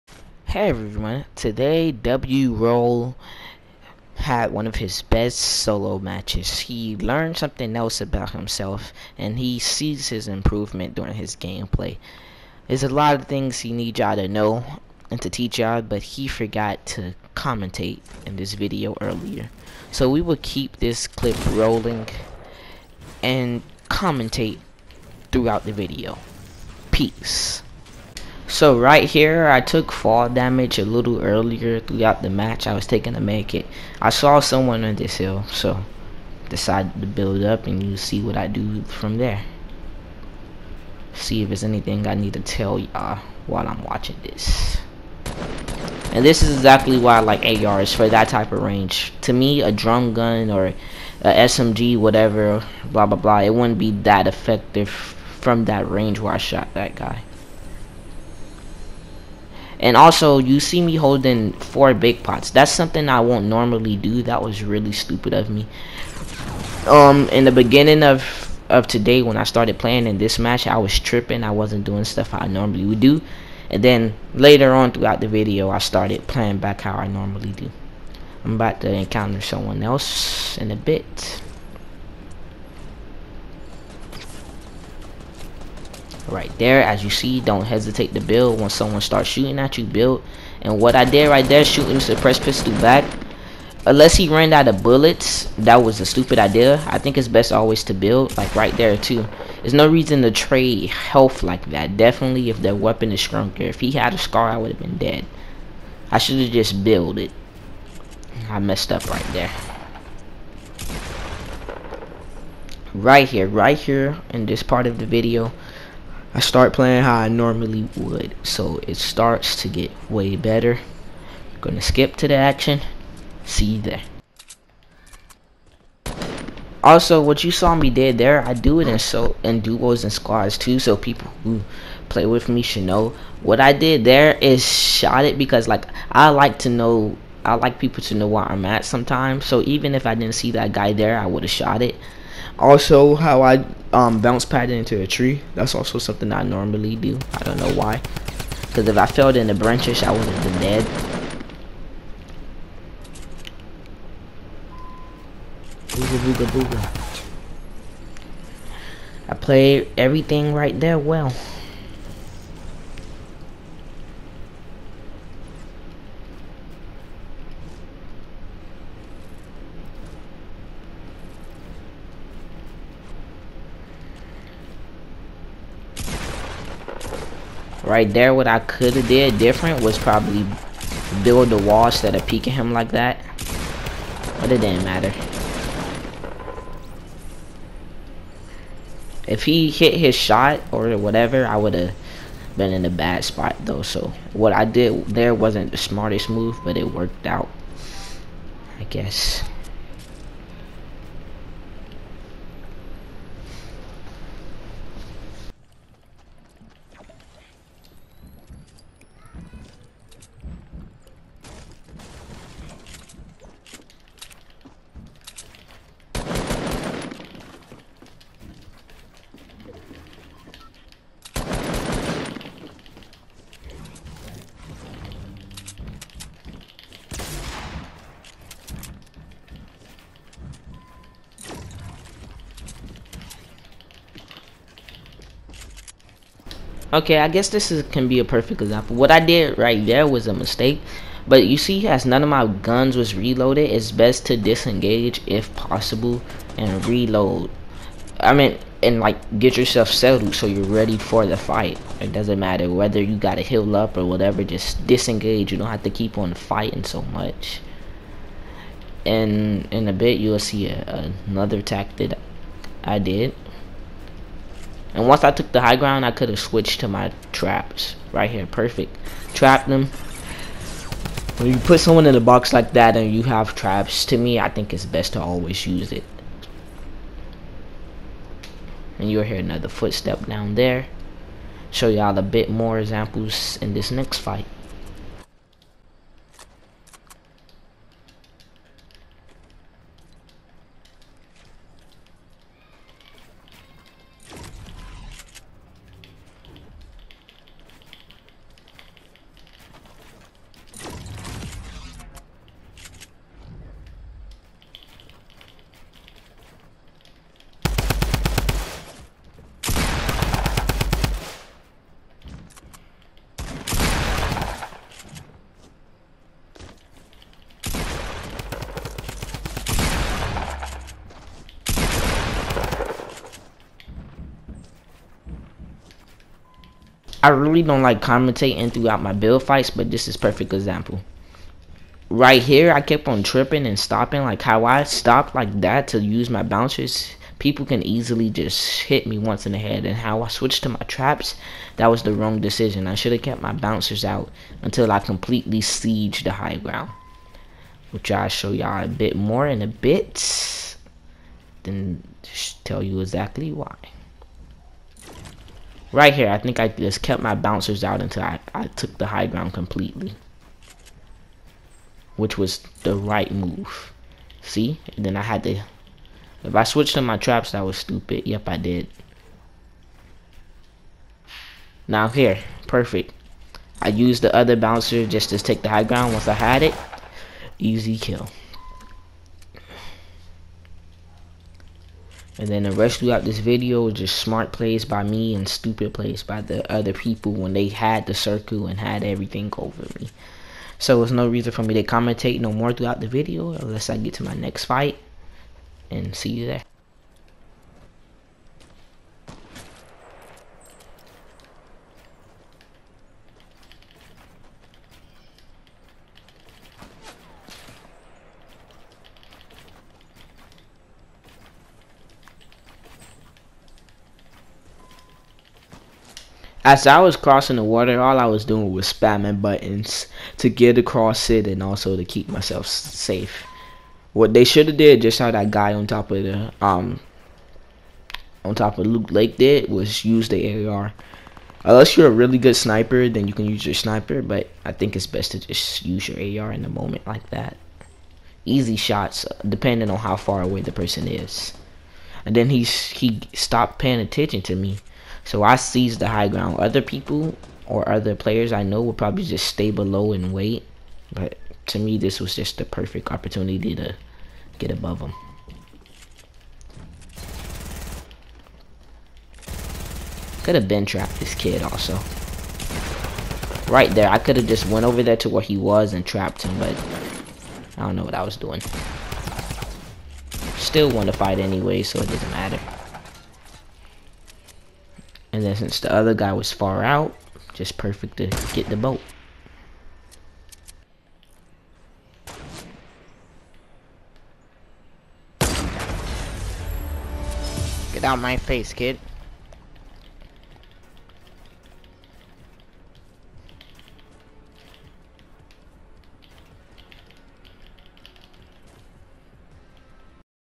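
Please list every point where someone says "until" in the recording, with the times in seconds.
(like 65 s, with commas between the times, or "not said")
344 s, 358 s.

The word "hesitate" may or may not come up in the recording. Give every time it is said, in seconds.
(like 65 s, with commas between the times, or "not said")
87 s.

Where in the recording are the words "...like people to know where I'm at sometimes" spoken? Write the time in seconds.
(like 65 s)
137 s.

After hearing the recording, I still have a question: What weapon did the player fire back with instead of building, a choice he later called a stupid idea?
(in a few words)
suppressed pistol.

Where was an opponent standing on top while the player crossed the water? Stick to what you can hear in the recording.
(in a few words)
Loot Lake.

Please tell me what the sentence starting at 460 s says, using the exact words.
Could have been trapped this kid also.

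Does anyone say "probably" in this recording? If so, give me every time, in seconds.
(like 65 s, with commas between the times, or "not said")
179 s, 448 s.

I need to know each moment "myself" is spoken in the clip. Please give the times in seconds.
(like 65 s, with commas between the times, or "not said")
422 s.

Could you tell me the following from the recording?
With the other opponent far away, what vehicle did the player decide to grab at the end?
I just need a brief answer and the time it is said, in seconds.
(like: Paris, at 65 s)
the boat, at 478 s.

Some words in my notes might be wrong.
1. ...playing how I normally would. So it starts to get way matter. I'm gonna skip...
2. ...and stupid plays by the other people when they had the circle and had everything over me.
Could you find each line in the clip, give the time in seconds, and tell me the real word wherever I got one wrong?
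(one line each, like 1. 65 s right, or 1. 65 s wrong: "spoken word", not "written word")
1. 116 s wrong: "better", not "matter"
2. 385 s right.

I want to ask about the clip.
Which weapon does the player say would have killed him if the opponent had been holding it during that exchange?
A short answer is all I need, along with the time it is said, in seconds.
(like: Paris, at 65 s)
scar, at 104 s.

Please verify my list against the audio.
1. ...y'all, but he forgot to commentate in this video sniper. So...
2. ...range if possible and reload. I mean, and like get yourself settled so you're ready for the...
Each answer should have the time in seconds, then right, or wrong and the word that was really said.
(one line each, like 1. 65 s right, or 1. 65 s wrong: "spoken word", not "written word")
1. 15 s wrong: "earlier", not "sniper"
2. 244 s wrong: "disengage", not "range".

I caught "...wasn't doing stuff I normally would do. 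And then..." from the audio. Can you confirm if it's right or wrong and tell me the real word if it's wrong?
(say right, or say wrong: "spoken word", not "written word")
right.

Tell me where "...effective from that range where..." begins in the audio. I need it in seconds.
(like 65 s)
54 s.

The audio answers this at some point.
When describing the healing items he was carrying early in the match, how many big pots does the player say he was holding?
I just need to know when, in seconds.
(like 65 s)
61 s.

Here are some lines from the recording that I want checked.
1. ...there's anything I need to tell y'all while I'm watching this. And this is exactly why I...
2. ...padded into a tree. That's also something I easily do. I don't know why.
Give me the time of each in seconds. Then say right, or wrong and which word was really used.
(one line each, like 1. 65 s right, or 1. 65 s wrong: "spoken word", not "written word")
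1. 41 s right
2. 144 s wrong: "normally", not "easily".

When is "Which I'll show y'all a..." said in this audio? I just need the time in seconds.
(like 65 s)
347 s.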